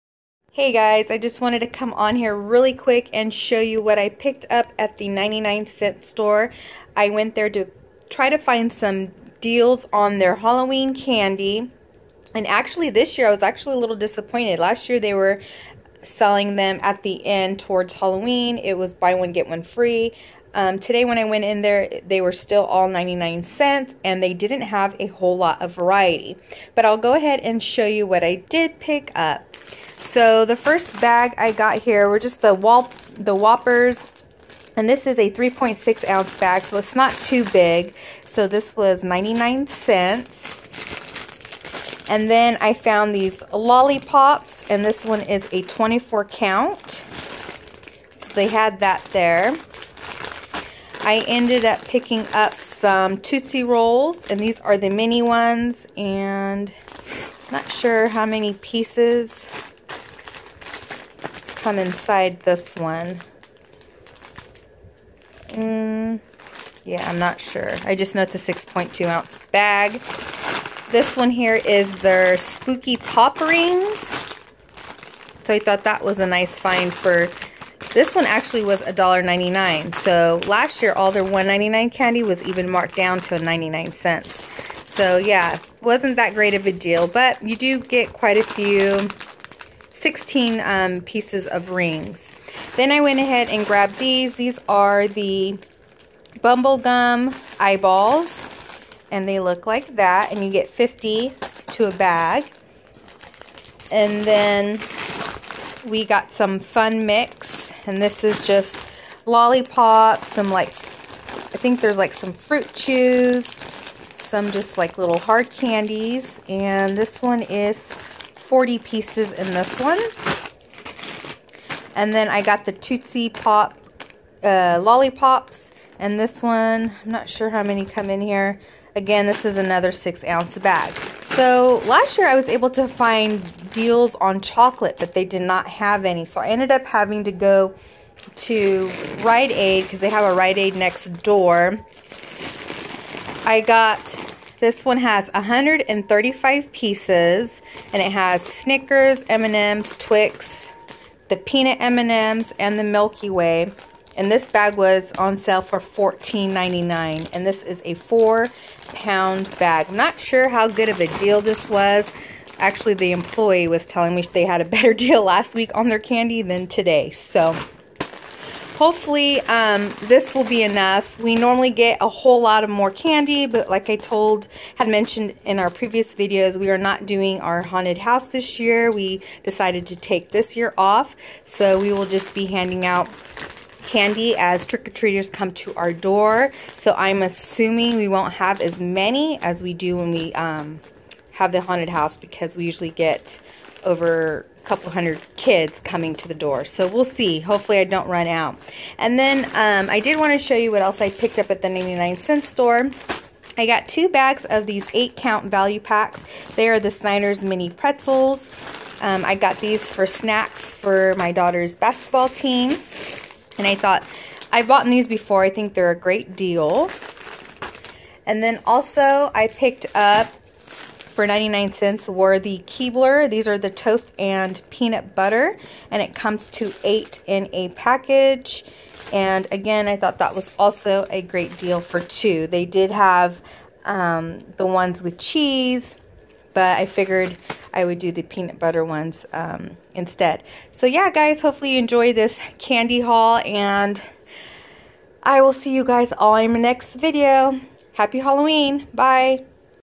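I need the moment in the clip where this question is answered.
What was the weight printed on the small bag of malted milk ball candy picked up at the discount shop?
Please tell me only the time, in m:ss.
0:35.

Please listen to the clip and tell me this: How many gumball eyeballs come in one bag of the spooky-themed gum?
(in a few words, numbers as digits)
50.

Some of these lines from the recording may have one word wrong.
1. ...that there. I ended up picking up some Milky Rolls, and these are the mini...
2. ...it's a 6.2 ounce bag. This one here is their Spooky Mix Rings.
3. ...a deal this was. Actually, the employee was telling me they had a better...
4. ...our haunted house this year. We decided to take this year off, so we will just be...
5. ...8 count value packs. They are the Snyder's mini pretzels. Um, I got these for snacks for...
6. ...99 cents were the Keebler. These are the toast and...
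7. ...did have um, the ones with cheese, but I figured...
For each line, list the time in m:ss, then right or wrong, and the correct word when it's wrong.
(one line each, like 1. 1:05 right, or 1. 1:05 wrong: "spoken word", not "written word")
1. 0:48 wrong: "Tootsie", not "Milky"
2. 1:08 wrong: "Pop", not "Mix"
3. 2:41 right
4. 2:57 right
5. 3:24 right
6. 3:41 right
7. 3:52 right.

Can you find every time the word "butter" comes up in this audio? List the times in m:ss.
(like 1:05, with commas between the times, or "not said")
3:45, 3:58.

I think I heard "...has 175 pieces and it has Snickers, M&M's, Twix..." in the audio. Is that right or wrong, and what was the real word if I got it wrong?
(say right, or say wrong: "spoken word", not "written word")
wrong: "135", not "175".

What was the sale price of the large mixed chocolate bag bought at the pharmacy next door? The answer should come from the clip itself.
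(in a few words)
$14.99.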